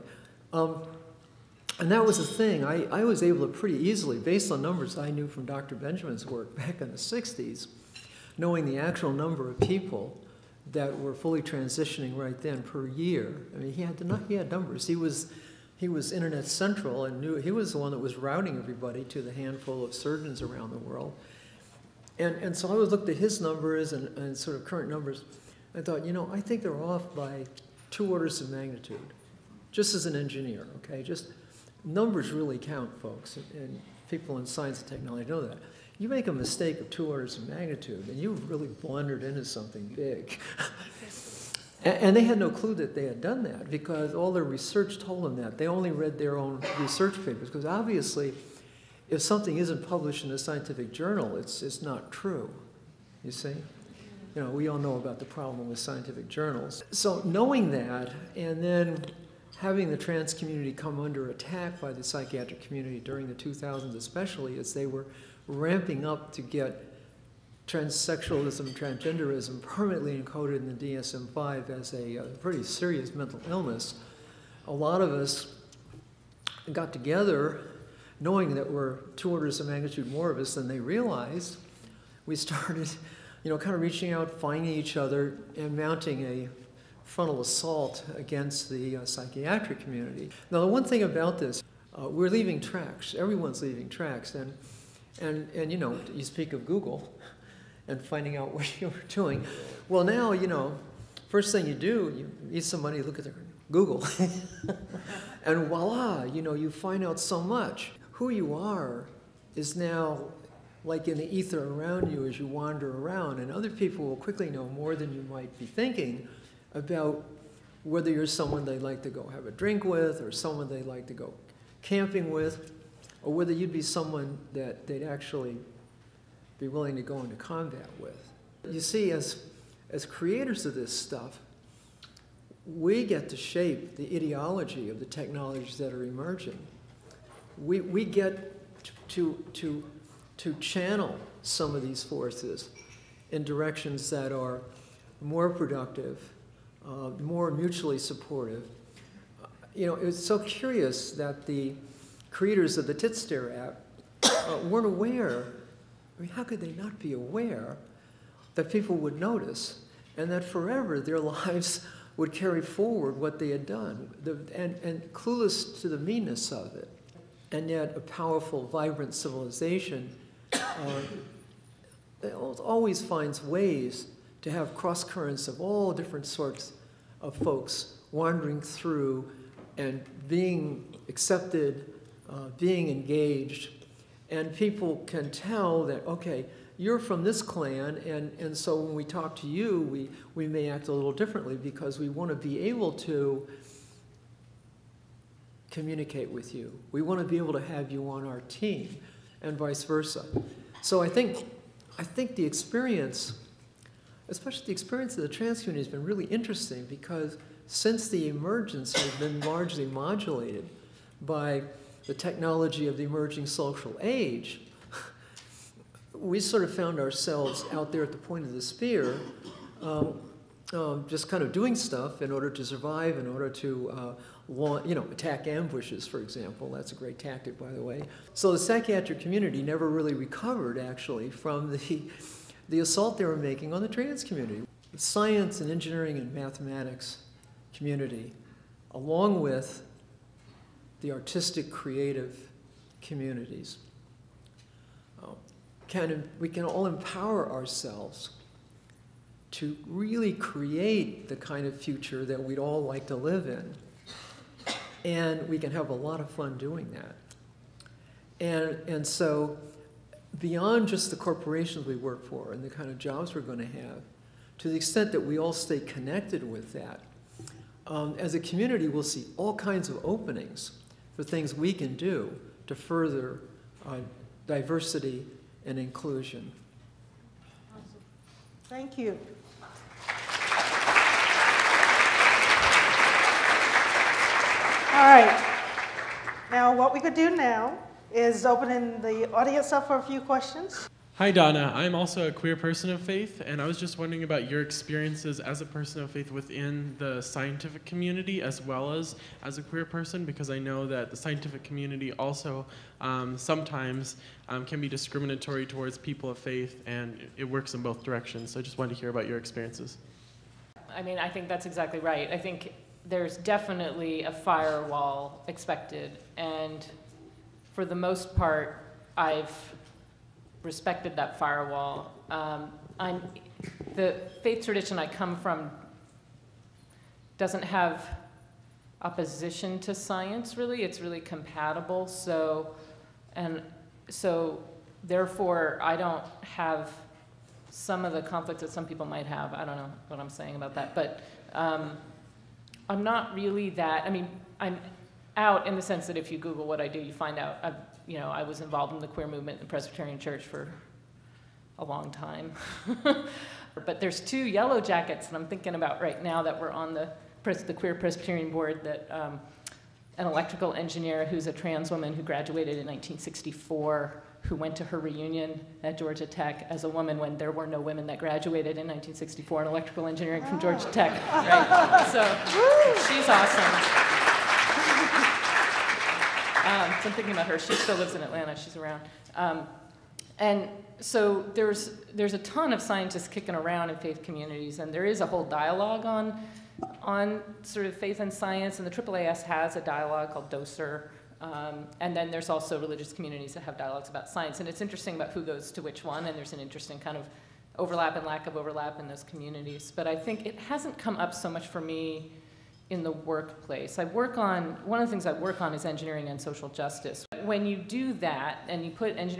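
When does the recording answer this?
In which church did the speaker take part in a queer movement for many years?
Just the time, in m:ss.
5:49.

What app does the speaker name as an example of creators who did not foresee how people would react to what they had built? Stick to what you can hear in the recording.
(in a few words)
Titstare.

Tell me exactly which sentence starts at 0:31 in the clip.
Just numbers really count, folks, and people in science and technology know that.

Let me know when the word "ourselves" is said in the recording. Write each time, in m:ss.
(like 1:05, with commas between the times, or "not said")
3:36, 4:07.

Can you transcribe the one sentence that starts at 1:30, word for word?
Now, the one thing about this, uh, we're leaving tracks.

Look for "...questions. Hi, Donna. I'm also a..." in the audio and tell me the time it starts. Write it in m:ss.
4:50.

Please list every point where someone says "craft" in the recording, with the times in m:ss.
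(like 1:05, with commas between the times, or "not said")
not said.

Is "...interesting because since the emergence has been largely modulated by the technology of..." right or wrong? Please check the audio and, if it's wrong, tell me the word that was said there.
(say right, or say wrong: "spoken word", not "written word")
right.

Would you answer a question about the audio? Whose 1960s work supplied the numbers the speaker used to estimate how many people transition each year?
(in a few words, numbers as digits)
Dr. Benjamin.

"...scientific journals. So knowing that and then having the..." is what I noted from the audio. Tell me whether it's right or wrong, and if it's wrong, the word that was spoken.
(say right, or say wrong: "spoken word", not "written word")
right.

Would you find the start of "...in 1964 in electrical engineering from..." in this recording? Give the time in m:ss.
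6:08.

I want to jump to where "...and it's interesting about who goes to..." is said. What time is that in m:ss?
6:34.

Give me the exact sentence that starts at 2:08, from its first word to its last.
You see, as, as creators of this stuff, we get to shape the ideology of the technologies that are emerging.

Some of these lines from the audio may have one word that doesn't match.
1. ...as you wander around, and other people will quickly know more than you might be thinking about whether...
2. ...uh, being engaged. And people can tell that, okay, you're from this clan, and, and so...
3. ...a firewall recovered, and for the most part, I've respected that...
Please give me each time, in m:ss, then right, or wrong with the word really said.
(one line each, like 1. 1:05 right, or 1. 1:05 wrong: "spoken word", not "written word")
1. 1:52 right
2. 3:02 right
3. 5:14 wrong: "expected", not "recovered".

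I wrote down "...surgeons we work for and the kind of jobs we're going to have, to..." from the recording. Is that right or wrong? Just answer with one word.
wrong.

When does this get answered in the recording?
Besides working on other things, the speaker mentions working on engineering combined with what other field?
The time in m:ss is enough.
6:46.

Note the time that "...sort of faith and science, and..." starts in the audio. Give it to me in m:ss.
6:27.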